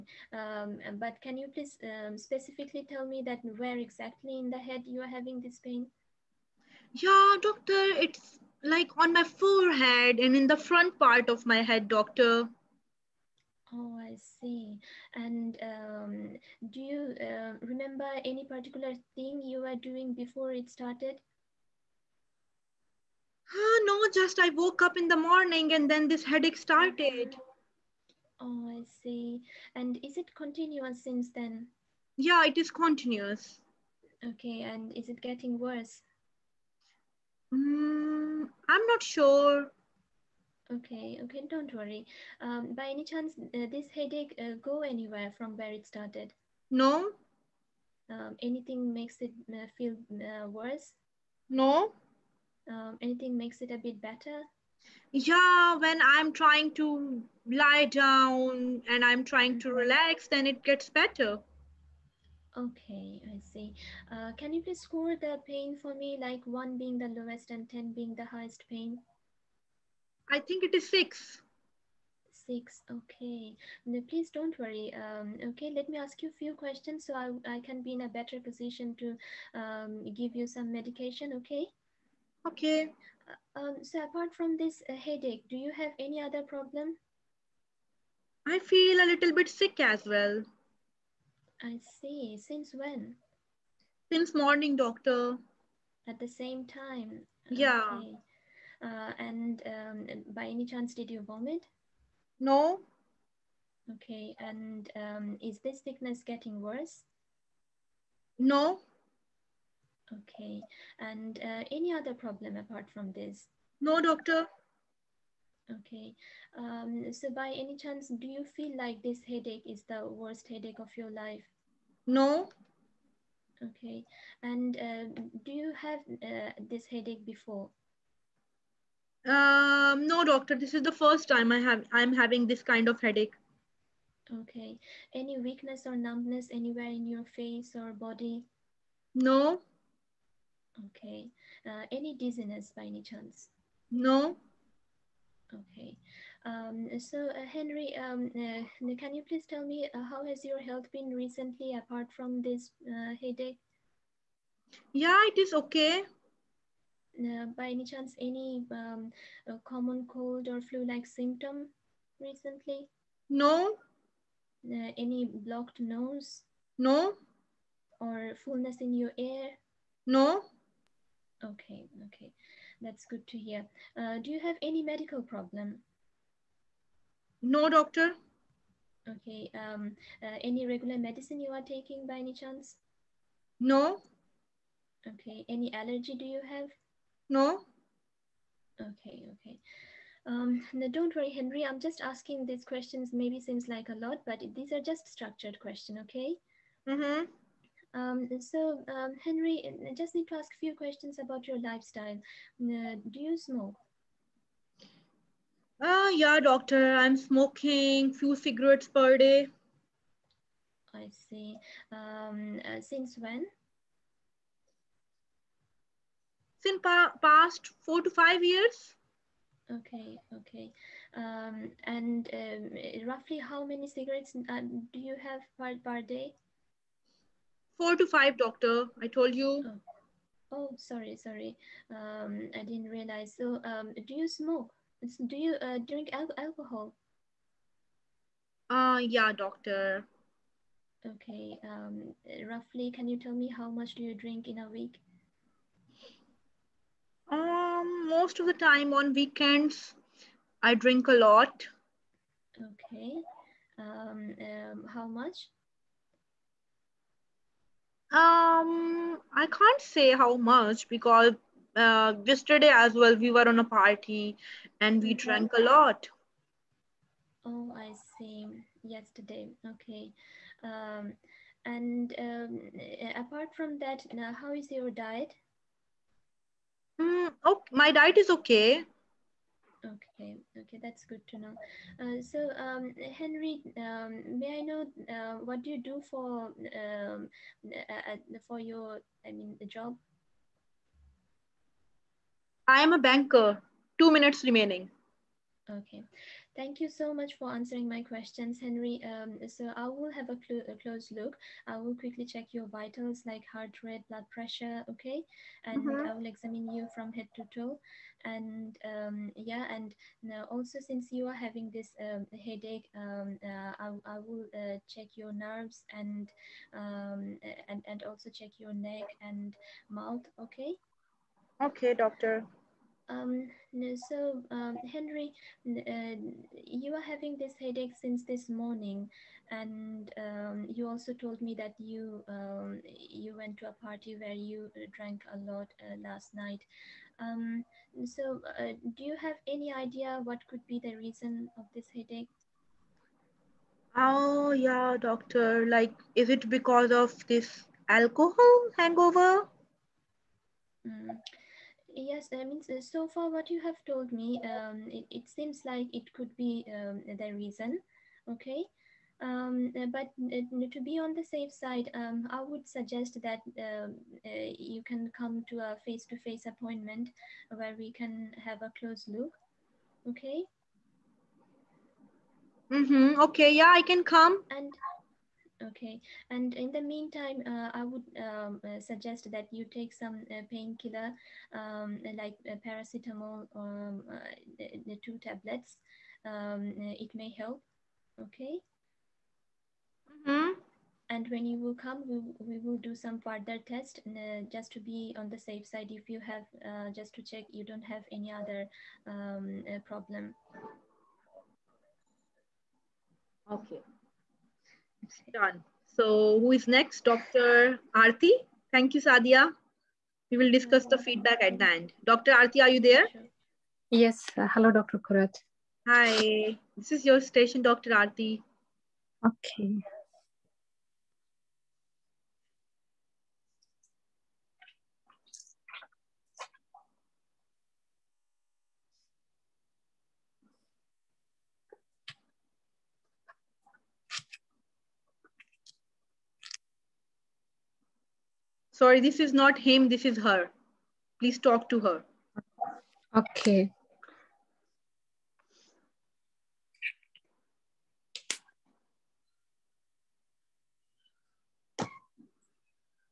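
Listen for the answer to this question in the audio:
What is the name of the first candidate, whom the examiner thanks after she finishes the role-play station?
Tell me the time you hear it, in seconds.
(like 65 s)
409 s.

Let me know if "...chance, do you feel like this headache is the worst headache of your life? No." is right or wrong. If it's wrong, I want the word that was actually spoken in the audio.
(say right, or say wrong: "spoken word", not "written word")
right.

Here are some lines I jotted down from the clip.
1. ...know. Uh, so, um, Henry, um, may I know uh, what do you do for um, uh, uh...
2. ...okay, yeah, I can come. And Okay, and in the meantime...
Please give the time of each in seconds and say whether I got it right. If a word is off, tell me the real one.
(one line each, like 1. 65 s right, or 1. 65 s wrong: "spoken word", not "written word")
1. 281 s right
2. 373 s right.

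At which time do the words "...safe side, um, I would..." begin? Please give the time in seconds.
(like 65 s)
361 s.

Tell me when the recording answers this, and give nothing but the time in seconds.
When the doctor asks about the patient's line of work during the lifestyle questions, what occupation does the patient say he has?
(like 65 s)
293 s.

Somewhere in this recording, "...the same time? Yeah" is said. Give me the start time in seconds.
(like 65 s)
96 s.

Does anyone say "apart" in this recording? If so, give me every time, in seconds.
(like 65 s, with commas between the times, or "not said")
84 s, 112 s, 151 s, 273 s.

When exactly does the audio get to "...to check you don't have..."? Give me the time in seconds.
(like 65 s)
397 s.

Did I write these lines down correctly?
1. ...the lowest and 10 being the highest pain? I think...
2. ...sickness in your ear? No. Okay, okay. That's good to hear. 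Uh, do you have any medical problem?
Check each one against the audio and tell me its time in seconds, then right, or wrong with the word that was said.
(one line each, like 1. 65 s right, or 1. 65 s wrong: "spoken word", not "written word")
1. 66 s right
2. 168 s wrong: "fullness", not "sickness".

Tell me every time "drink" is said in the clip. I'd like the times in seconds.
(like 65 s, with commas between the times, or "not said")
235 s, 244 s, 250 s.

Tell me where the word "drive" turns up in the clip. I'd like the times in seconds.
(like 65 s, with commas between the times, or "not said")
not said.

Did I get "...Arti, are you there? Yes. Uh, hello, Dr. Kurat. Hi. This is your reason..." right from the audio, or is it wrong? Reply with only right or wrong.
wrong.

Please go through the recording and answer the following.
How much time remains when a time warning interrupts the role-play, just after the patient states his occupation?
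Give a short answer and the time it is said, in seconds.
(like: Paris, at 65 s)
2 minutes, at 293 s.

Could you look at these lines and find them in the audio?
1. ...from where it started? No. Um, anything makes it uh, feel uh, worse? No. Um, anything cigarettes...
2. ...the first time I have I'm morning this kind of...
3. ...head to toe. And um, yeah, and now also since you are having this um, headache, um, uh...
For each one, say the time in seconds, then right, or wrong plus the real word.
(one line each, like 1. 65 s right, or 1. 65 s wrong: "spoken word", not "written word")
1. 45 s wrong: "makes", not "cigarettes"
2. 130 s wrong: "having", not "morning"
3. 307 s right.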